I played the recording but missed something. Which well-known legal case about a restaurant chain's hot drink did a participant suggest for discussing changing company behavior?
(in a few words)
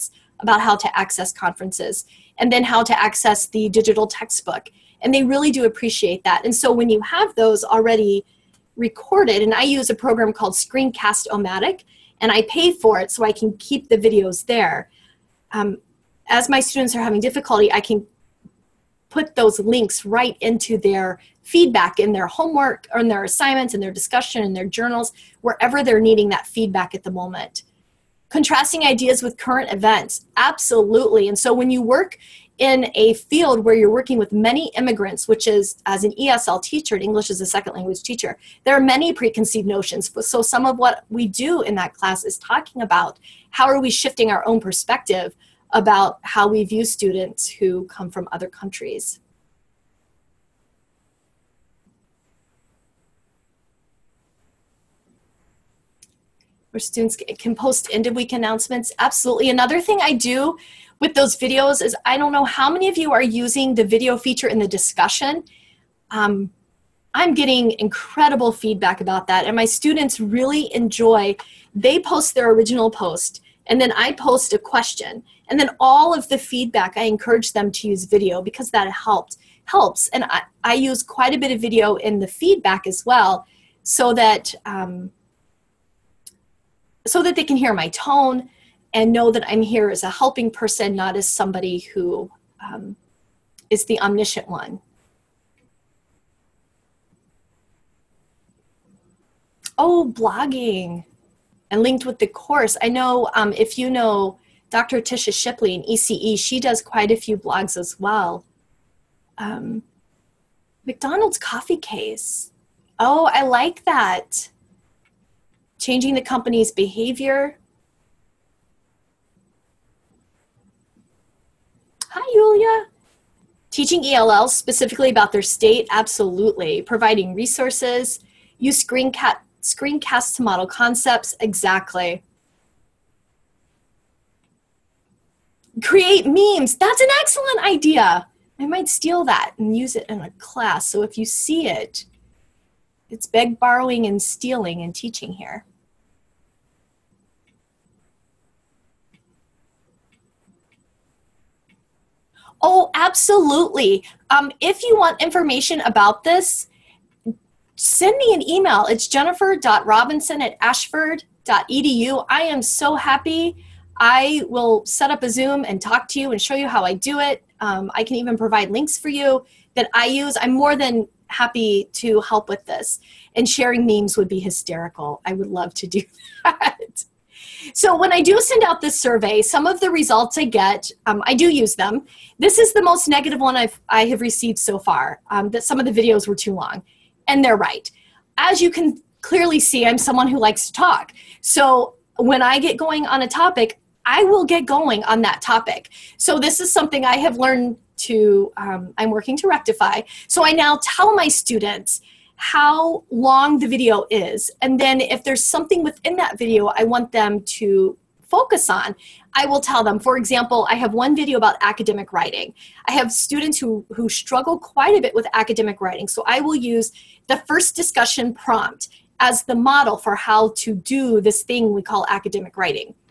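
McDonald's coffee case.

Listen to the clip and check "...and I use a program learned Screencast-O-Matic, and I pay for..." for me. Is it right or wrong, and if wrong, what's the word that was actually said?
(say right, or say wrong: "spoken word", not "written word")
wrong: "called", not "learned".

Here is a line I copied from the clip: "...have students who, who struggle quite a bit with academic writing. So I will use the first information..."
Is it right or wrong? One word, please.
wrong.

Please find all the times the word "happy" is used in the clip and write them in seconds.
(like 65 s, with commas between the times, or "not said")
162 s, 171 s.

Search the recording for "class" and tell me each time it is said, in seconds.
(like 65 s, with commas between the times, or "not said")
41 s, 140 s.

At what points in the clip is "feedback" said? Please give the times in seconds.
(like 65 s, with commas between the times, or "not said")
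21 s, 26 s, 68 s, 76 s, 82 s.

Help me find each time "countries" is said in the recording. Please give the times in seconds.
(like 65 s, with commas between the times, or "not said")
48 s.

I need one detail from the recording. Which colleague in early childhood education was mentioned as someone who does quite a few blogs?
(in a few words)
Dr. Tisha Shipley.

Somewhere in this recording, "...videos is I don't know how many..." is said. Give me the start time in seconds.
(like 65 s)
61 s.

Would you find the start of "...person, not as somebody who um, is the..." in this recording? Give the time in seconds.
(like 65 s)
90 s.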